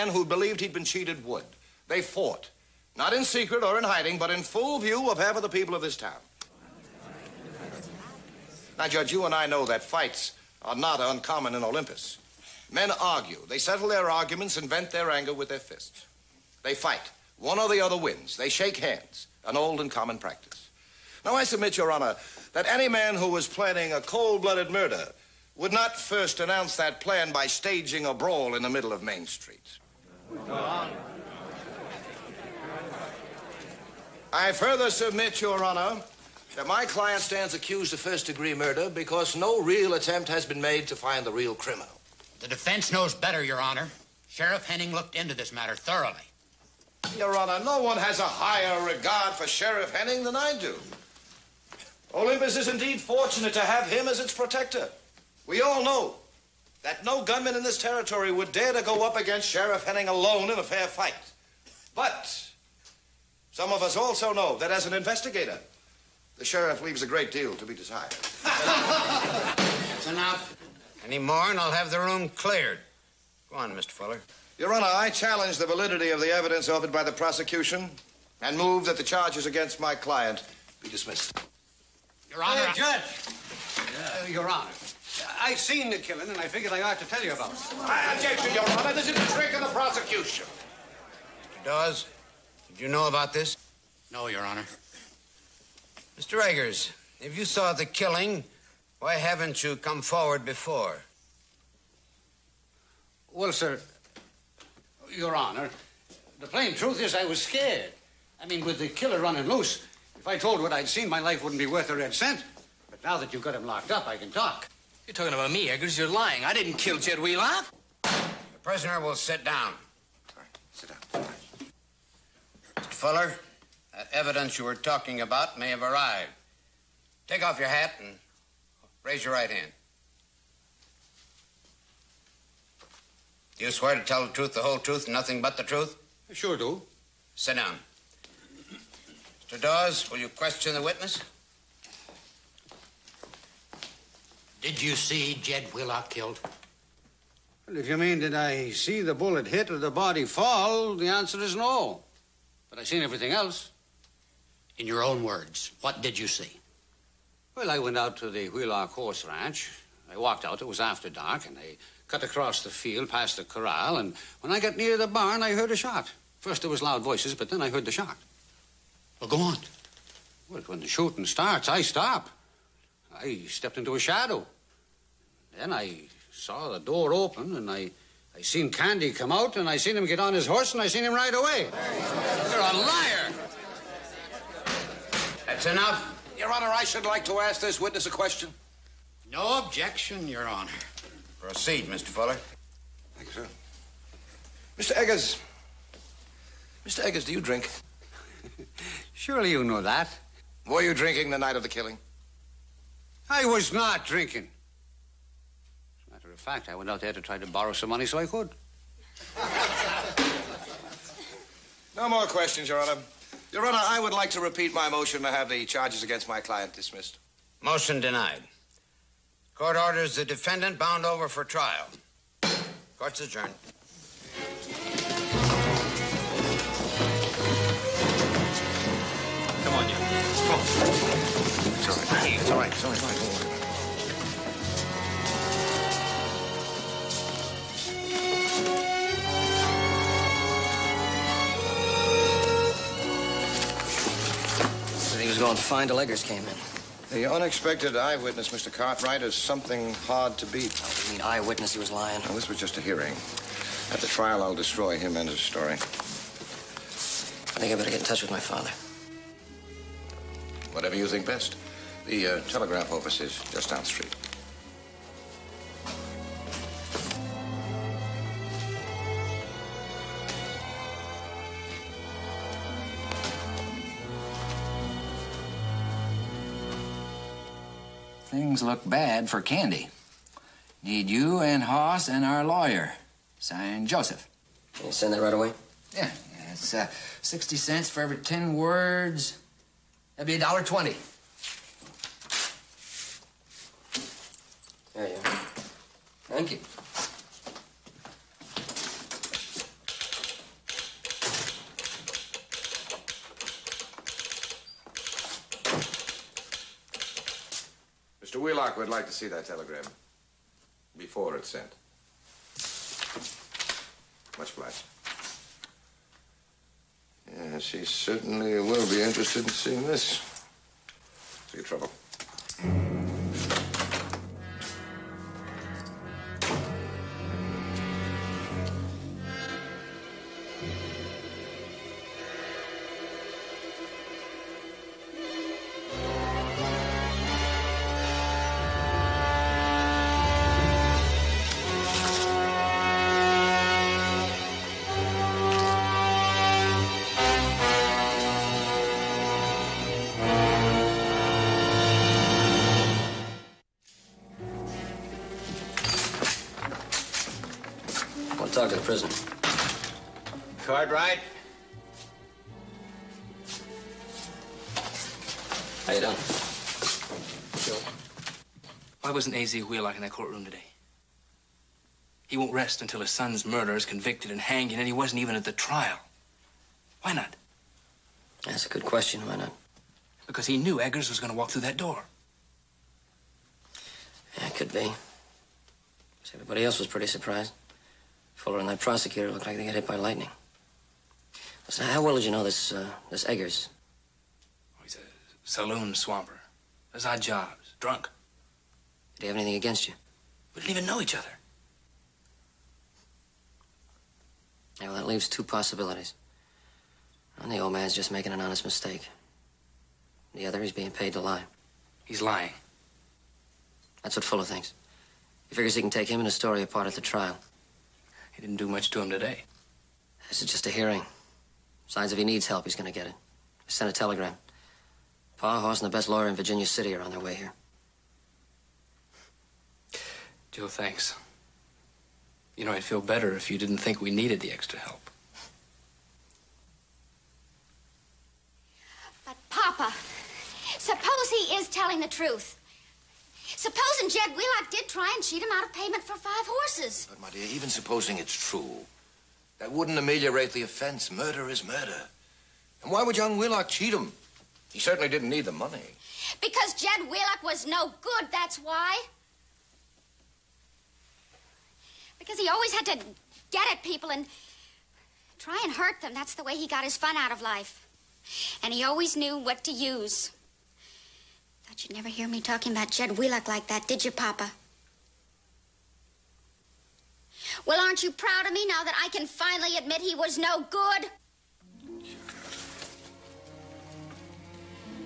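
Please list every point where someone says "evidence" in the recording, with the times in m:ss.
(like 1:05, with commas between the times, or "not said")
1:16, 2:04.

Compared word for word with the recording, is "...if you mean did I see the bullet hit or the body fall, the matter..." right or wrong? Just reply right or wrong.
wrong.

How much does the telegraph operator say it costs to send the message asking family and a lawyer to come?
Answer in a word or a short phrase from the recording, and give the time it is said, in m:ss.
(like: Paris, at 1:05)
$1.20, at 4:50.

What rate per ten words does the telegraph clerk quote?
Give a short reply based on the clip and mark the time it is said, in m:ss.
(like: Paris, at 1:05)
60 cents, at 4:47.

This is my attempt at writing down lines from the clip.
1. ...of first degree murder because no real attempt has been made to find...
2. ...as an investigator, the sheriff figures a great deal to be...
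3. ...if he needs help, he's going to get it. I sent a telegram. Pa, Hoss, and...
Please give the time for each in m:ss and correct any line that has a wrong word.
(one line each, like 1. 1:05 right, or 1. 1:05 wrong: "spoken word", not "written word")
1. 0:37 right
2. 1:04 wrong: "leaves", not "figures"
3. 7:02 right.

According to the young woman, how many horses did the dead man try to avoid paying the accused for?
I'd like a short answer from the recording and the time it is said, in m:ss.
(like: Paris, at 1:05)
5, at 7:26.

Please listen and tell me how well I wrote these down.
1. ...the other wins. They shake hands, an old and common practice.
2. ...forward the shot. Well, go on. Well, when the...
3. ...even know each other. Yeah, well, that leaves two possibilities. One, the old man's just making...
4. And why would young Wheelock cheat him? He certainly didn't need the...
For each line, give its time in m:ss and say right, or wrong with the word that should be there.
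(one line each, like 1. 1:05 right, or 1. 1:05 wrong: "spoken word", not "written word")
1. 0:17 right
2. 2:47 wrong: "heard", not "forward"
3. 6:40 right
4. 7:32 right.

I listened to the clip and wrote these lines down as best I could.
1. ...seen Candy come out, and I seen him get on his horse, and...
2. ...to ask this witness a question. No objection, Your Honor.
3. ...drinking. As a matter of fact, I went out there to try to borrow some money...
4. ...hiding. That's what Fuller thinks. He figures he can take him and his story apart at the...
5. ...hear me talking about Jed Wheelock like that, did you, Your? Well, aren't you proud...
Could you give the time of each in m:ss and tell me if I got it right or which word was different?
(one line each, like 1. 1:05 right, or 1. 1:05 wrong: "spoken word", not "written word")
1. 2:58 right
2. 3:07 right
3. 3:24 right
4. 6:52 wrong: "lying", not "hiding"
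5. 7:52 wrong: "Papa", not "Your".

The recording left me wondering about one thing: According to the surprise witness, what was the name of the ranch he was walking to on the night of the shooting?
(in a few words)
Wheelock Horse Ranch.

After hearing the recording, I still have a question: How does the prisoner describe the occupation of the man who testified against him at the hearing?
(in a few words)
Saloon swamper.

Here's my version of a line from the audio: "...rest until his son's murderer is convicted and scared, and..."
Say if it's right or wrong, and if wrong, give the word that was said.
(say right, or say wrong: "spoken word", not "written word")
wrong: "hanged", not "scared".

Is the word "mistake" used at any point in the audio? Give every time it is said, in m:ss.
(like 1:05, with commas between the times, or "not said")
6:48.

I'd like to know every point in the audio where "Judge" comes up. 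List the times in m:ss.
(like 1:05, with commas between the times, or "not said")
0:08, 1:22.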